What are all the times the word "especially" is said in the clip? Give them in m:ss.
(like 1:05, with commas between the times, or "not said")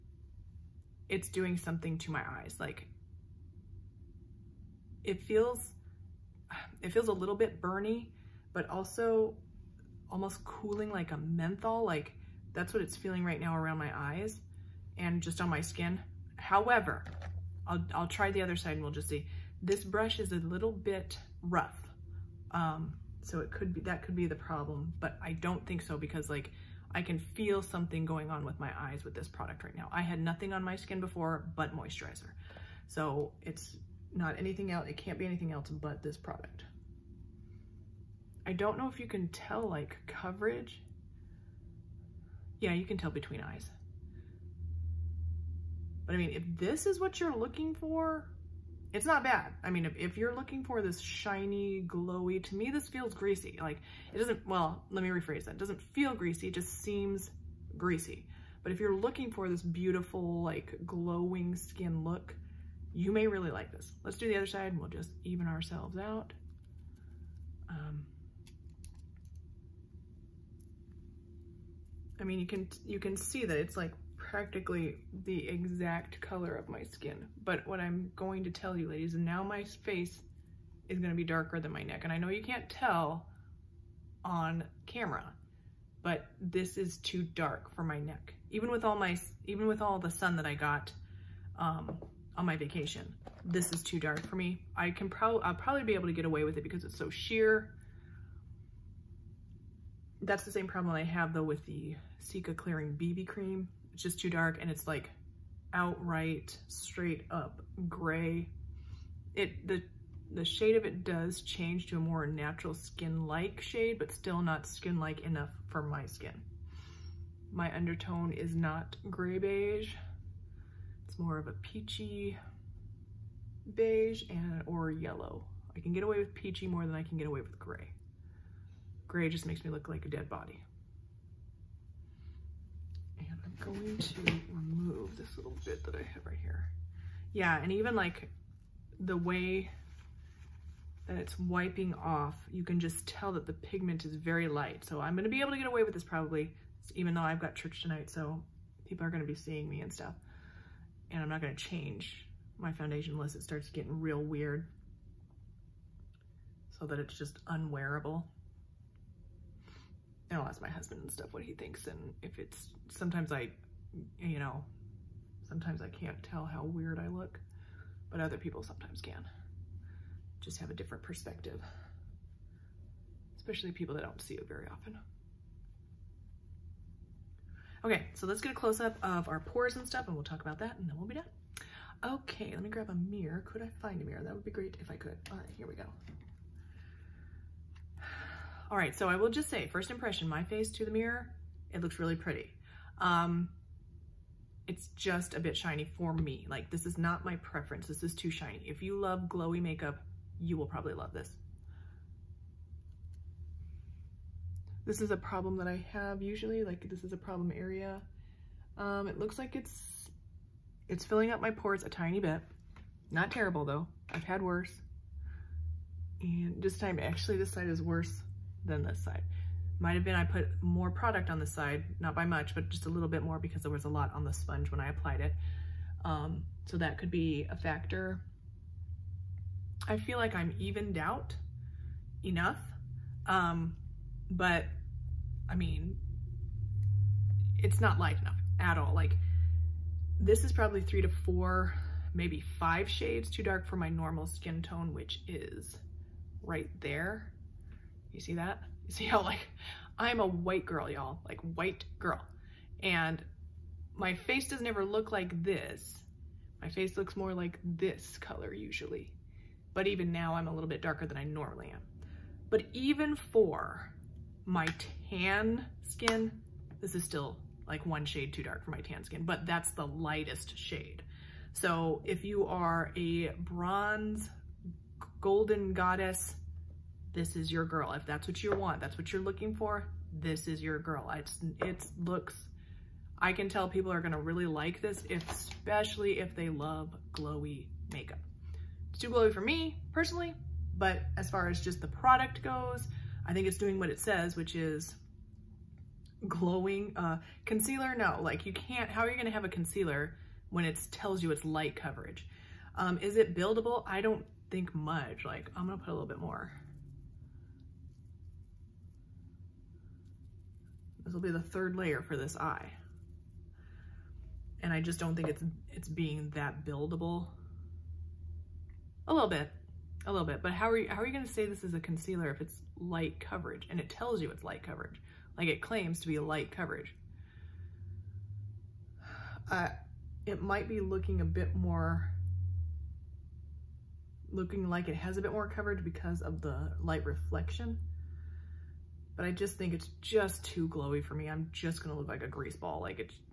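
2:53, 4:45.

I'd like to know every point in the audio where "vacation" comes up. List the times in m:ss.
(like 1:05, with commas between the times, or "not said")
1:32.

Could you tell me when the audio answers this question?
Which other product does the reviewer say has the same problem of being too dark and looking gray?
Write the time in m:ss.
1:42.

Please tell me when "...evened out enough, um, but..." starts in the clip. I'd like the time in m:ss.
3:50.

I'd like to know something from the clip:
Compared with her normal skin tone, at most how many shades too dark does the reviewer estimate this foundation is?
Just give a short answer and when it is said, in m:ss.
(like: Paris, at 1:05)
5, at 4:02.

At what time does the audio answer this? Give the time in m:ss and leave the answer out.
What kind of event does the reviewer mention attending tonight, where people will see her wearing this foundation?
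2:27.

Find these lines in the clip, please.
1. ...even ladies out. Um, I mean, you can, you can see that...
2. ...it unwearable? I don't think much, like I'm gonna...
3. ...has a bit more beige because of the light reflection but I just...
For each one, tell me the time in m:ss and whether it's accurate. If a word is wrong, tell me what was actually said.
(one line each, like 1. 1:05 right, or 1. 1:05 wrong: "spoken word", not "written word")
1. 1:05 wrong: "ourselves", not "ladies"
2. 5:03 wrong: "buildable", not "unwearable"
3. 5:34 wrong: "coverage", not "beige".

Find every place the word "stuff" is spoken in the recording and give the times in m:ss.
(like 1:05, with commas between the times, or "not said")
2:29, 2:41, 2:59.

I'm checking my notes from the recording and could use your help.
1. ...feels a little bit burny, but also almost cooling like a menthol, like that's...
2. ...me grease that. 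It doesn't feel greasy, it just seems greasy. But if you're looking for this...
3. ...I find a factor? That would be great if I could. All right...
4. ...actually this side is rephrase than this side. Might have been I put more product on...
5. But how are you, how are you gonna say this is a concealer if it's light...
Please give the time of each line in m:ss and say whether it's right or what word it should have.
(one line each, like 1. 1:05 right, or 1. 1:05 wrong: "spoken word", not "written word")
1. 0:06 right
2. 0:55 wrong: "rephrase", not "grease"
3. 3:03 wrong: "mirror", not "factor"
4. 3:36 wrong: "worse", not "rephrase"
5. 5:20 right.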